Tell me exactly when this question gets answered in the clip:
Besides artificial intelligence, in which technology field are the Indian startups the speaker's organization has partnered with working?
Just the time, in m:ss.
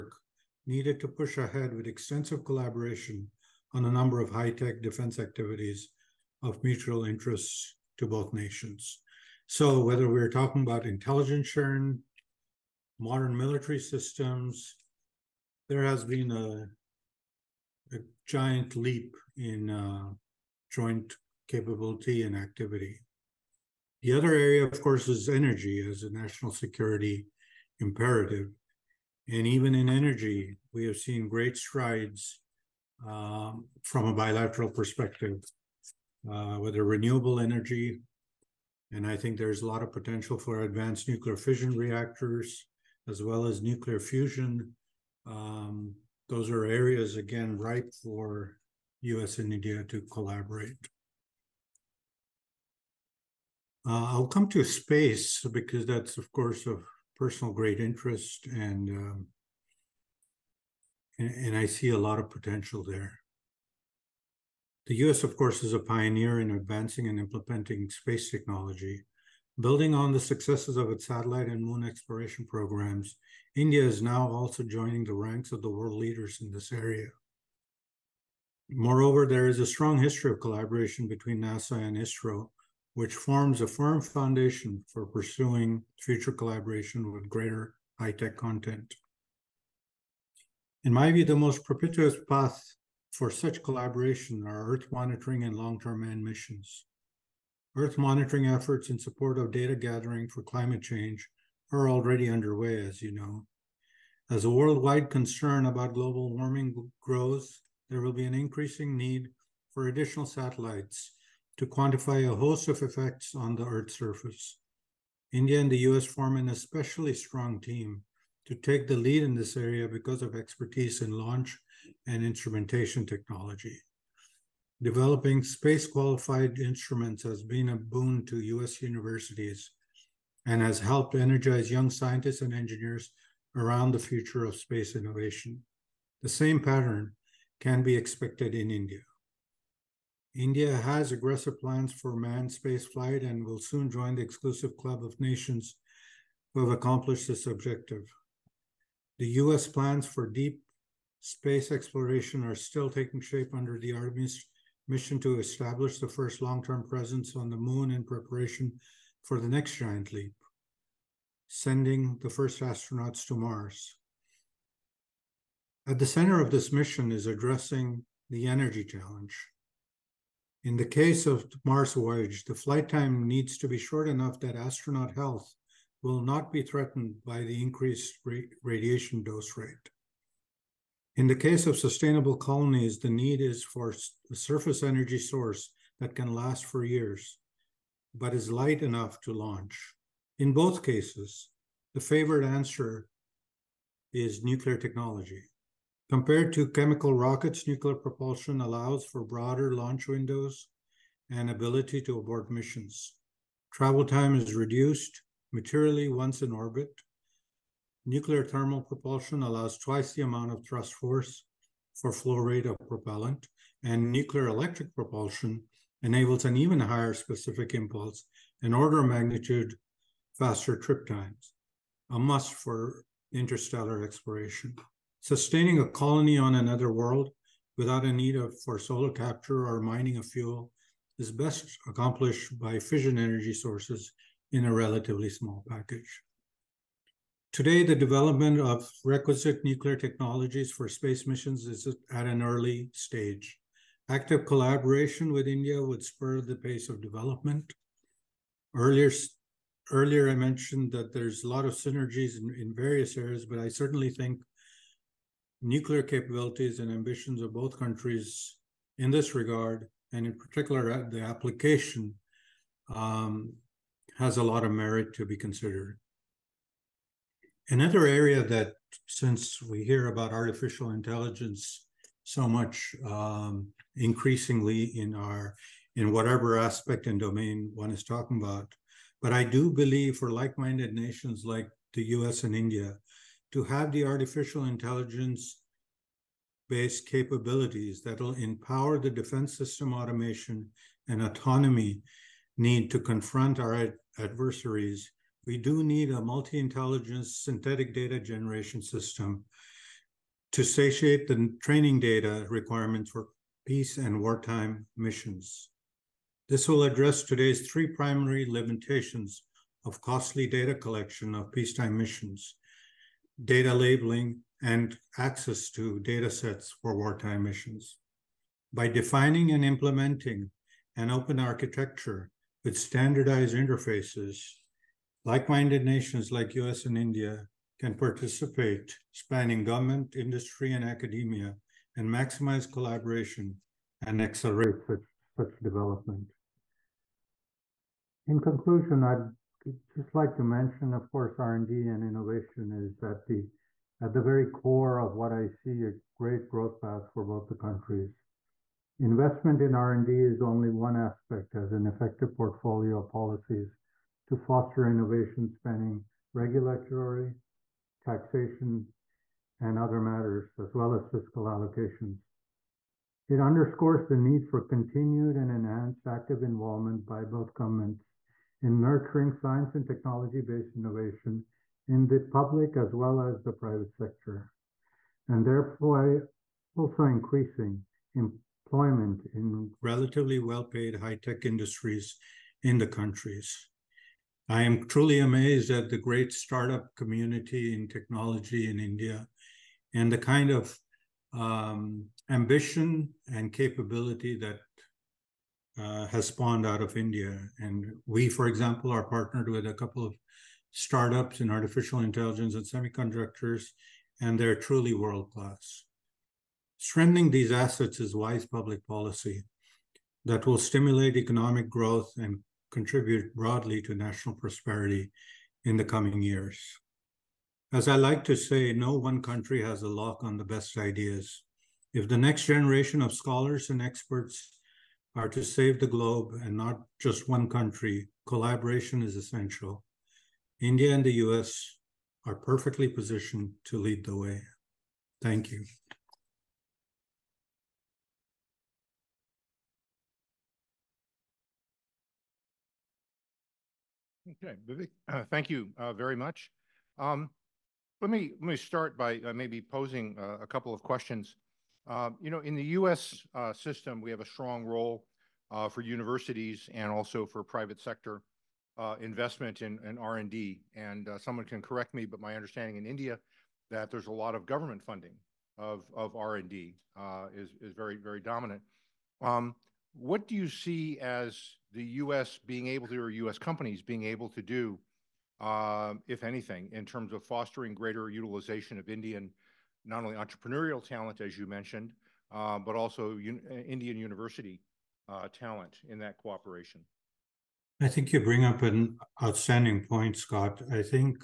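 6:42.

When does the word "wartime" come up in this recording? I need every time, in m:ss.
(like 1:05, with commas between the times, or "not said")
5:04, 5:16.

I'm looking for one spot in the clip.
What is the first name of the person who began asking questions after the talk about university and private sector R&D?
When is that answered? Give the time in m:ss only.
8:10.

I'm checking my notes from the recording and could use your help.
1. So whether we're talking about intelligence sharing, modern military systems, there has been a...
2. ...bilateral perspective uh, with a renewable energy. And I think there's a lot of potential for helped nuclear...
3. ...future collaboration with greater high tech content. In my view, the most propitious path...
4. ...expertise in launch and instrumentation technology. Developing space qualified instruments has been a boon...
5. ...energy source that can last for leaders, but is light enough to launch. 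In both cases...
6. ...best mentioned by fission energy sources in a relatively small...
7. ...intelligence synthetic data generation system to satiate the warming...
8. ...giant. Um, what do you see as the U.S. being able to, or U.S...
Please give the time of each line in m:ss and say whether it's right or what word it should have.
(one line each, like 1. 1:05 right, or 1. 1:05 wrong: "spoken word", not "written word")
1. 0:09 right
2. 0:34 wrong: "advanced", not "helped"
3. 1:26 right
4. 2:00 right
5. 3:04 wrong: "years", not "leaders"
6. 3:51 wrong: "accomplished", not "mentioned"
7. 4:56 wrong: "training", not "warming"
8. 7:48 wrong: "dominant", not "giant".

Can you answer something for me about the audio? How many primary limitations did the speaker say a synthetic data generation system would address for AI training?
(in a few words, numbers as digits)
3.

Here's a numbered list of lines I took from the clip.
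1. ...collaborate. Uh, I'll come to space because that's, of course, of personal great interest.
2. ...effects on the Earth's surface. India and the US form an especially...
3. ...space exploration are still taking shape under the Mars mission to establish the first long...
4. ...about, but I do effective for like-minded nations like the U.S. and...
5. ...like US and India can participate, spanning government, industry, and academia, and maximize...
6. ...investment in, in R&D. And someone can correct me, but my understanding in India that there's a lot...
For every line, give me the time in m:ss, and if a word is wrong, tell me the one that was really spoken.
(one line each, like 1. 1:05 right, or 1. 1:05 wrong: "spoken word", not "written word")
1. 0:50 right
2. 1:52 right
3. 2:31 wrong: "Artemis", not "Mars"
4. 4:38 wrong: "believe", not "effective"
5. 5:26 right
6. 7:38 right.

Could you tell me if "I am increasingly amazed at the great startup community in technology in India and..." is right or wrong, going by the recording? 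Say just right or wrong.
wrong.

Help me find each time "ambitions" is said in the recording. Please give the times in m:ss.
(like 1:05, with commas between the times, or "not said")
4:16, 6:32.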